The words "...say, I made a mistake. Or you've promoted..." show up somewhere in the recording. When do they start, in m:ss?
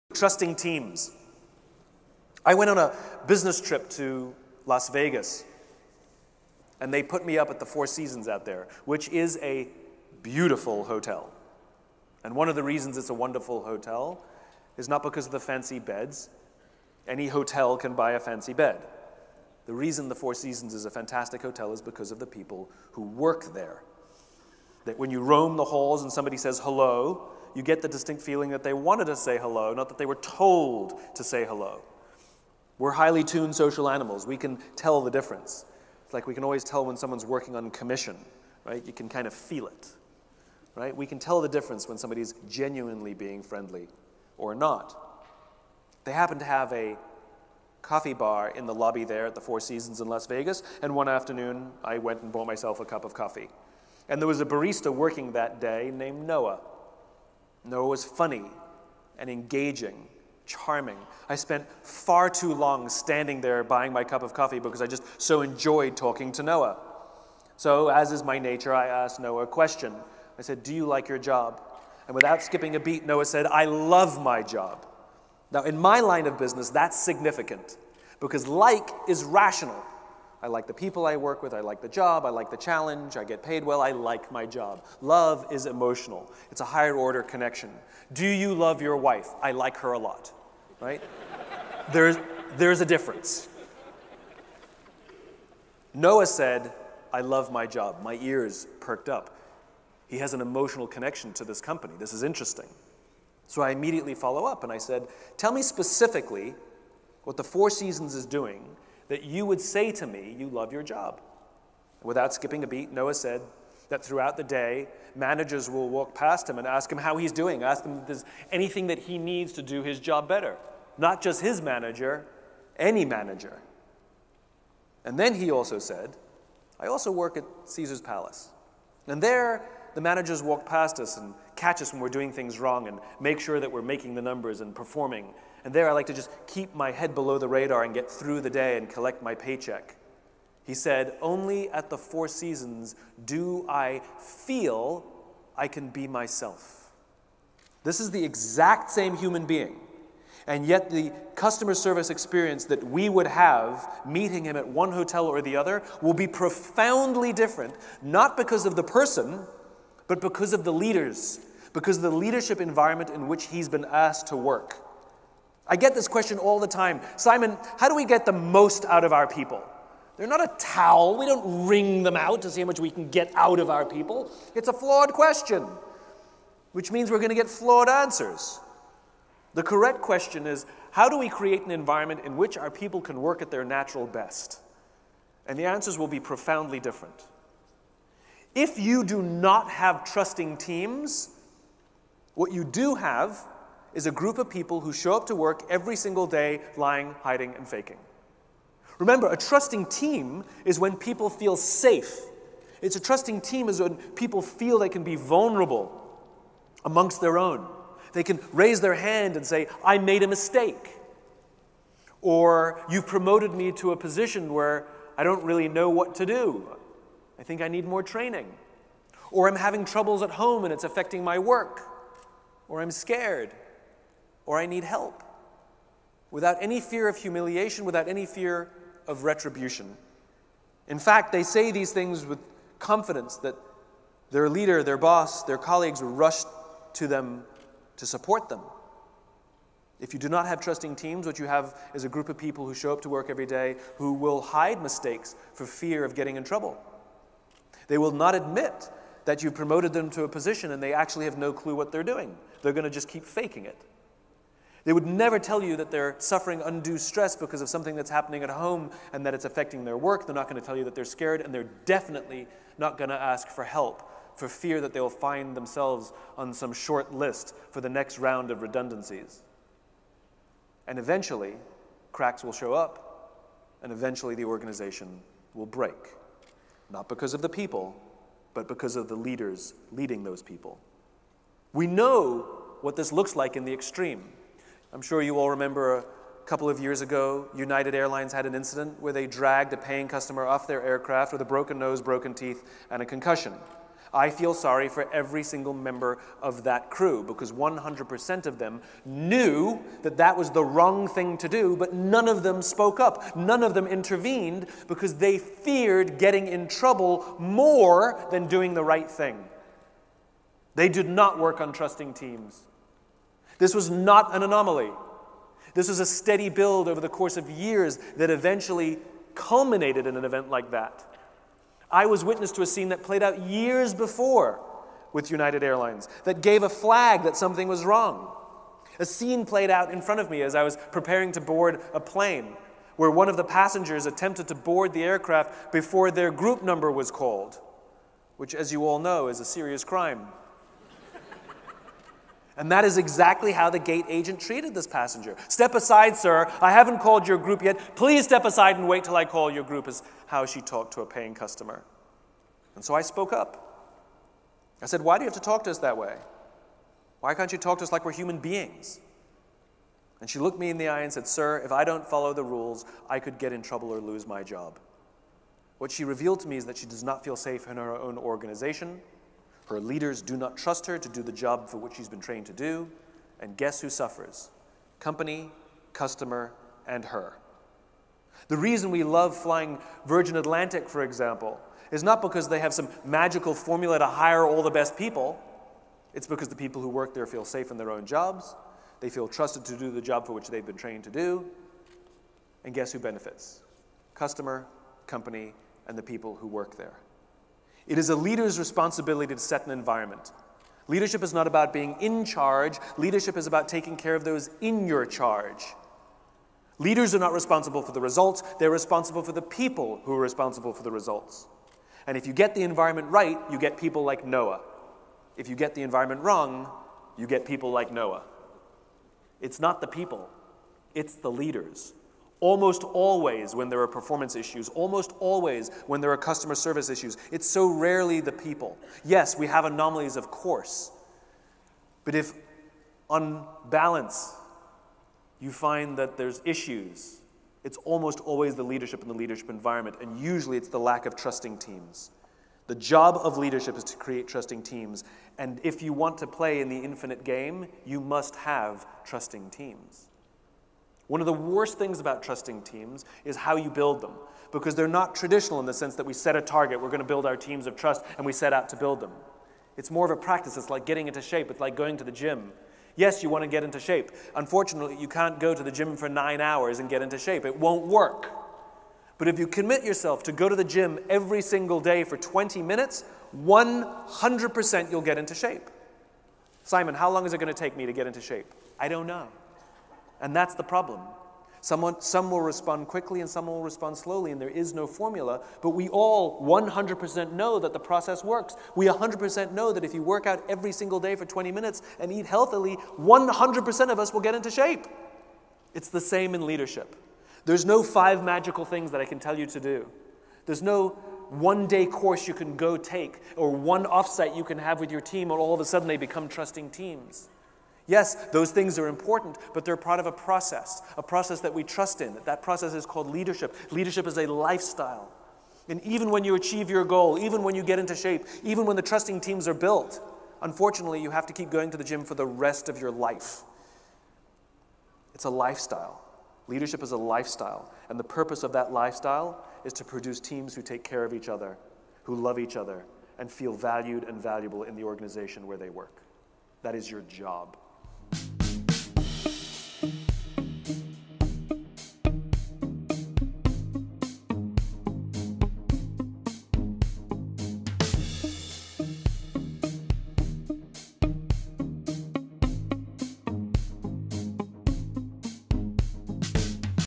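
3:29.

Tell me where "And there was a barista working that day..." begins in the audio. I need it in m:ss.
0:54.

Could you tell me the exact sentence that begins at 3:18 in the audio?
Remember, a trusting team is when people feel safe.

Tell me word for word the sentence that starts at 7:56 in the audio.
Simon, how long is it going to take me to get into shape?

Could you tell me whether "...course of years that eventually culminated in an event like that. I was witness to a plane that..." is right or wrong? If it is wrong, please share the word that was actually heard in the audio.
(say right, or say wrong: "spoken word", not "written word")
wrong: "scene", not "plane".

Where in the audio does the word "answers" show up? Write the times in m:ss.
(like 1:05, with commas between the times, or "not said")
2:57, 3:05.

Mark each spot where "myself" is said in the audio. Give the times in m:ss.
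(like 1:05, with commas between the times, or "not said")
0:52, 2:26.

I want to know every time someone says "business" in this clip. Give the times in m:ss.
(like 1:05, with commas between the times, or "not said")
0:03, 1:16.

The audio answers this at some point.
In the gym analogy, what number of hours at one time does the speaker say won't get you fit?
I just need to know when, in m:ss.
7:46.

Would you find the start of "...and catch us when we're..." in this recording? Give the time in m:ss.
2:11.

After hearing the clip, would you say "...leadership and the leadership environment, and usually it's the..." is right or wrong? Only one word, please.
right.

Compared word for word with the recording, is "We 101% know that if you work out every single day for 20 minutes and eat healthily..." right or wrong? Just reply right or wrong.
wrong.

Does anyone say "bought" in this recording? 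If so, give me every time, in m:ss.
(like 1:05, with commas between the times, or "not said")
0:52.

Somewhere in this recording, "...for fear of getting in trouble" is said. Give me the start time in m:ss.
4:05.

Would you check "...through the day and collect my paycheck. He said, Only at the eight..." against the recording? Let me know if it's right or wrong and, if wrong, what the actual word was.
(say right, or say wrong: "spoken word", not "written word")
wrong: "four", not "eight".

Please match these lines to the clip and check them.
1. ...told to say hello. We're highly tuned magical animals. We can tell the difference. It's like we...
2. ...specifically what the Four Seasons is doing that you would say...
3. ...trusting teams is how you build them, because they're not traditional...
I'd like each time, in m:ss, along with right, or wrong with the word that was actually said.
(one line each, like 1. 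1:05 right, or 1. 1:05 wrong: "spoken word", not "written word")
1. 0:30 wrong: "social", not "magical"
2. 1:45 right
3. 7:32 right.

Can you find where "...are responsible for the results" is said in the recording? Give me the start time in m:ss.
6:50.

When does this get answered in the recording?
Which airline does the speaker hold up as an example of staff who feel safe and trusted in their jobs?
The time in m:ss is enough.
6:20.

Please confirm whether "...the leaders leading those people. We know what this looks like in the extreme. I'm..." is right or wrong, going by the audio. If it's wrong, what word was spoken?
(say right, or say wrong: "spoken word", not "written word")
right.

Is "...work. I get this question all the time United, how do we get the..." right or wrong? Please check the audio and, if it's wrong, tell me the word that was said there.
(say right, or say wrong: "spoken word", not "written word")
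wrong: "Simon", not "United".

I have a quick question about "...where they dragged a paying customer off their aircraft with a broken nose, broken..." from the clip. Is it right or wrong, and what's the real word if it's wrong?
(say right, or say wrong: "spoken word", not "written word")
right.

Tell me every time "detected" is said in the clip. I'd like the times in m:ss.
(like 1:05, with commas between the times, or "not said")
not said.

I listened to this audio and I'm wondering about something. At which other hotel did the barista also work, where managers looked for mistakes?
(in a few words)
Caesar's Palace.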